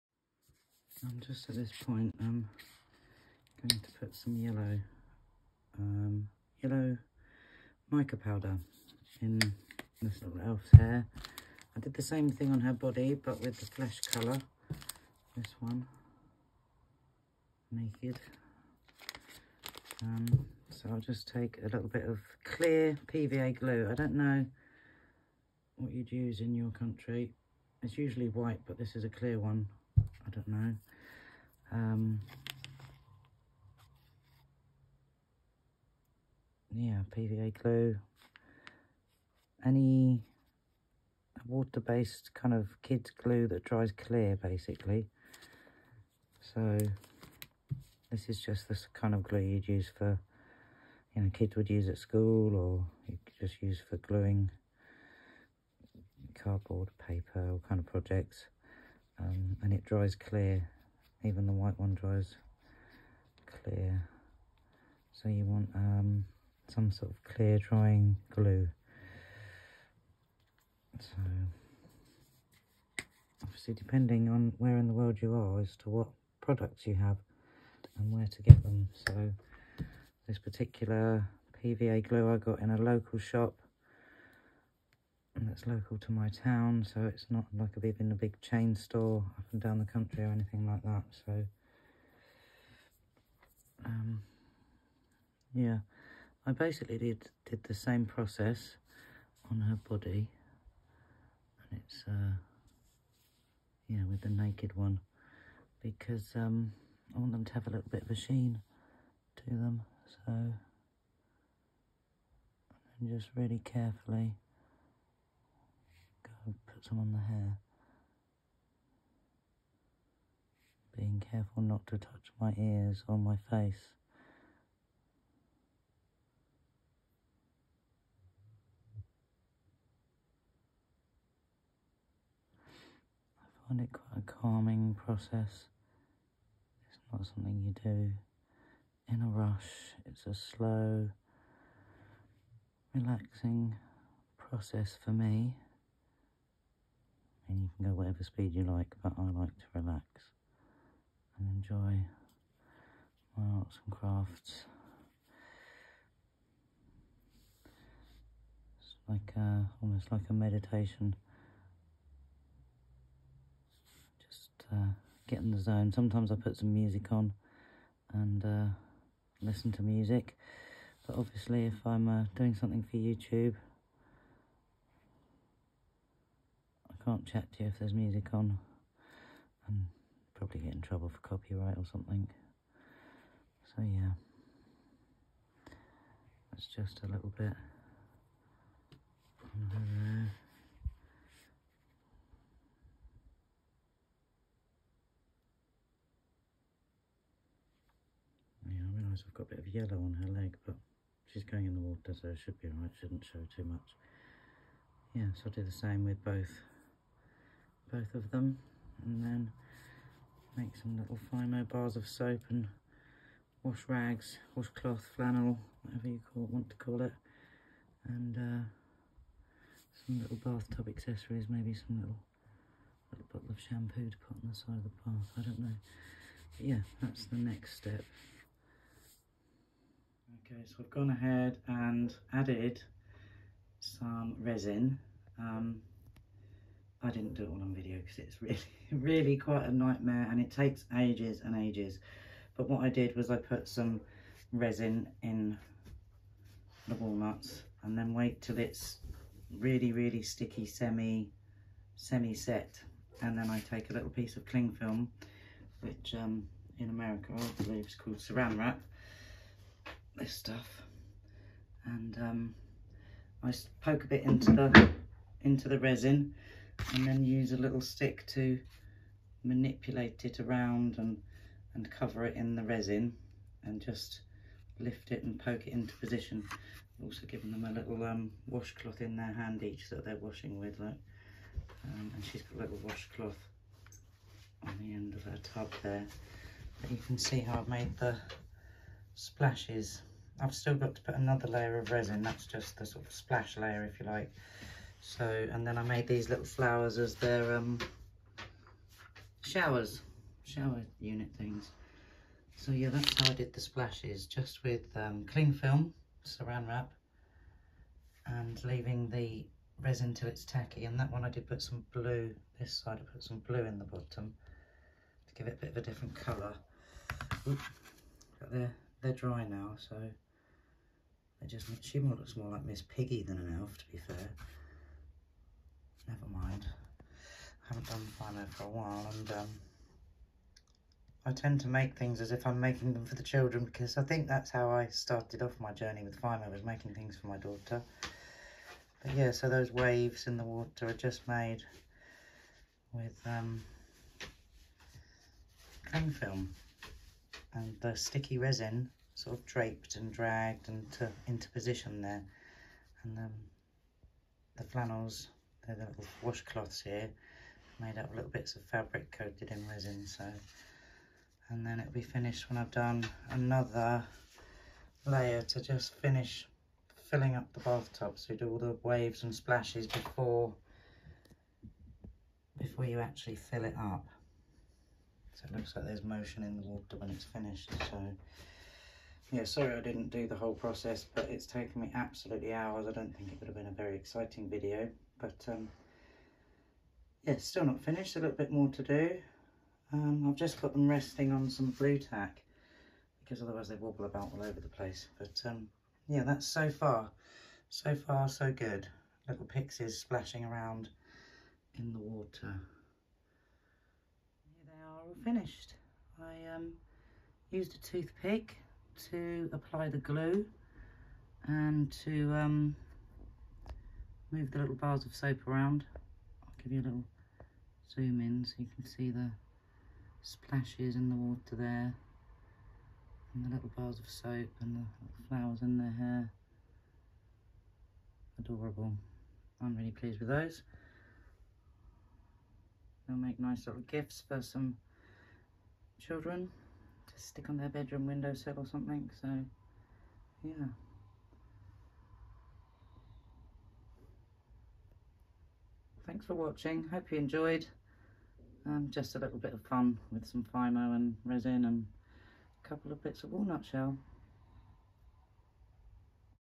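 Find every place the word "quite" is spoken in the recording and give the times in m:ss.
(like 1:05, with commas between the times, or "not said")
2:13, 3:59.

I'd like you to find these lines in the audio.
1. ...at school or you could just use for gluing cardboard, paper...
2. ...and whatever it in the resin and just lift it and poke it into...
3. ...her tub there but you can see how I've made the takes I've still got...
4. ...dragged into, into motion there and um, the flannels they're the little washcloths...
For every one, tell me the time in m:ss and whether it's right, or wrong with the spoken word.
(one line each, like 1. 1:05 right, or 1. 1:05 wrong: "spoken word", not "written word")
1. 0:51 right
2. 4:31 wrong: "cover", not "whatever"
3. 4:45 wrong: "splashes", not "takes"
4. 5:50 wrong: "position", not "motion".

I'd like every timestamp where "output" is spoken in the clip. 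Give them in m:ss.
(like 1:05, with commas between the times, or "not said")
not said.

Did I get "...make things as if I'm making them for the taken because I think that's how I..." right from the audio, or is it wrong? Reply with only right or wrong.
wrong.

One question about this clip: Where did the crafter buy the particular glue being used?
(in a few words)
A local shop.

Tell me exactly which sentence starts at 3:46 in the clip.
But yeah, that's the next step.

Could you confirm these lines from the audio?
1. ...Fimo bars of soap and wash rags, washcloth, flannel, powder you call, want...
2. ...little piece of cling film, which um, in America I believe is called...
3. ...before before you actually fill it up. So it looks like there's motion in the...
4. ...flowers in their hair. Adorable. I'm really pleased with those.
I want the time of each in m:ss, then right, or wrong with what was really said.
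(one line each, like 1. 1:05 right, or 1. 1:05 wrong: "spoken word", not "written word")
1. 3:31 wrong: "whatever", not "powder"
2. 4:13 right
3. 6:09 right
4. 7:05 right.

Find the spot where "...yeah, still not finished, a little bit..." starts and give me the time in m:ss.
6:27.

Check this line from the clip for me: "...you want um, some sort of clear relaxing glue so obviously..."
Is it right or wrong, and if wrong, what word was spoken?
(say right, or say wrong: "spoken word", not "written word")
wrong: "drying", not "relaxing".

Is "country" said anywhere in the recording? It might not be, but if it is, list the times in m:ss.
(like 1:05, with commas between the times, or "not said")
0:26, 1:29.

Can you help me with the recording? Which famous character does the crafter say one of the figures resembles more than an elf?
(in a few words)
Miss Piggy.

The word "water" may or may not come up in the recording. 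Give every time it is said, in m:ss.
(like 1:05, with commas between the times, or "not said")
0:41, 3:21, 5:40, 6:16, 6:41, 7:01.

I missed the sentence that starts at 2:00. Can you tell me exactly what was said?
Being careful not to touch my ears or my face.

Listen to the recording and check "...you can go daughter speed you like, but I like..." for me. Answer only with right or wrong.
wrong.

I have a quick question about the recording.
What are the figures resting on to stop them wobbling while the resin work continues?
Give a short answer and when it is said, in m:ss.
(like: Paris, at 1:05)
Blue tack, at 6:31.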